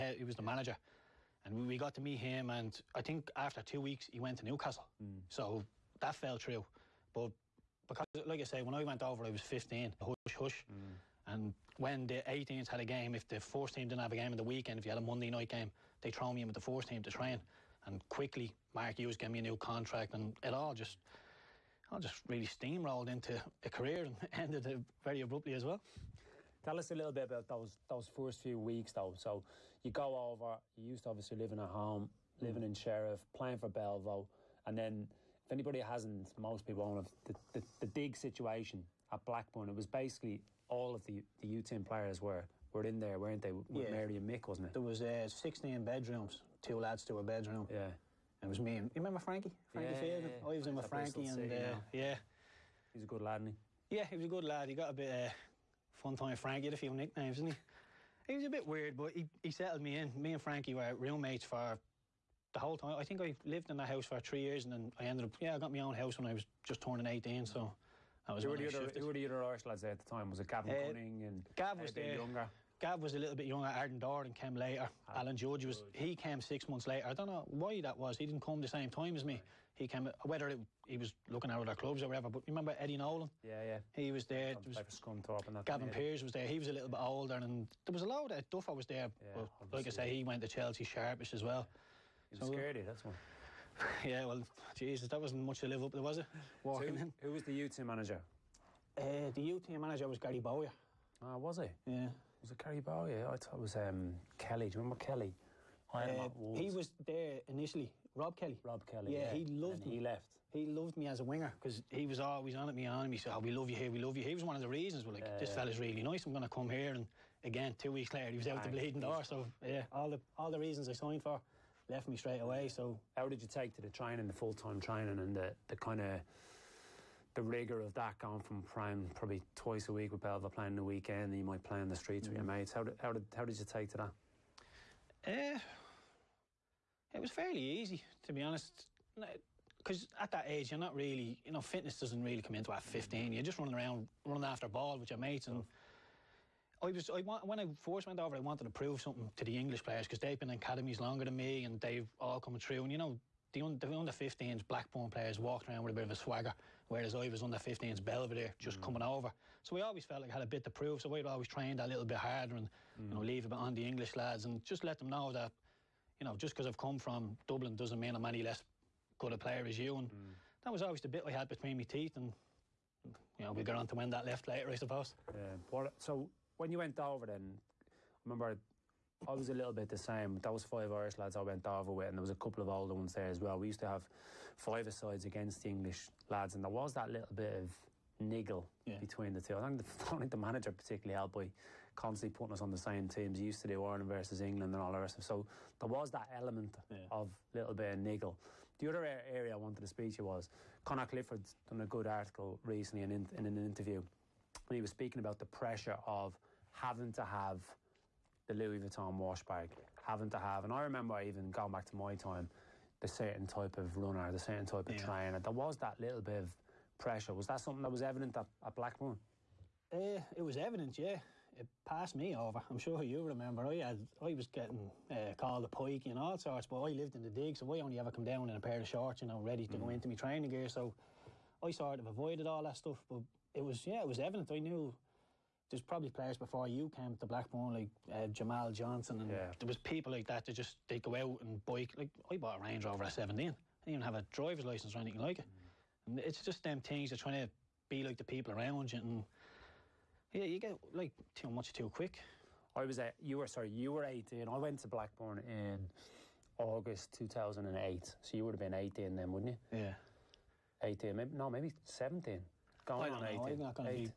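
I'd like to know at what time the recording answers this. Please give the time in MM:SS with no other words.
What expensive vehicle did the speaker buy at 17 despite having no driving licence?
04:02.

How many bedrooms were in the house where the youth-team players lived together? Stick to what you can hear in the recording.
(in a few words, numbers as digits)
16.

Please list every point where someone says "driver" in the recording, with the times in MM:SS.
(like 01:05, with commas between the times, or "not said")
04:04.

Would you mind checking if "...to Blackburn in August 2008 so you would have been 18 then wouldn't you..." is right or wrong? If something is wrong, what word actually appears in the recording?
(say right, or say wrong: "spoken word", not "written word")
right.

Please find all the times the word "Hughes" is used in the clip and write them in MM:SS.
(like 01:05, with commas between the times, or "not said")
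00:18.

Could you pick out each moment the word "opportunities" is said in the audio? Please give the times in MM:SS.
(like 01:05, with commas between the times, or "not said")
not said.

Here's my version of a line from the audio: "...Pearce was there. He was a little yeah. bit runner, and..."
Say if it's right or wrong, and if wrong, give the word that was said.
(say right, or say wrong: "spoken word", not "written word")
wrong: "older", not "runner".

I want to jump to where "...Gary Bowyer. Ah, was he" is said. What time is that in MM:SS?
01:40.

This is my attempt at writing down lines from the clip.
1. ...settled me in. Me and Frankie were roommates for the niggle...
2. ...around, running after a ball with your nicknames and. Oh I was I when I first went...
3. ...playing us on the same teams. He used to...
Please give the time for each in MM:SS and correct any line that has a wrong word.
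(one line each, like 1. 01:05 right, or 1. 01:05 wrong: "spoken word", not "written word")
1. 00:59 wrong: "whole", not "niggle"
2. 02:23 wrong: "mates", not "nicknames"
3. 03:12 wrong: "putting", not "playing".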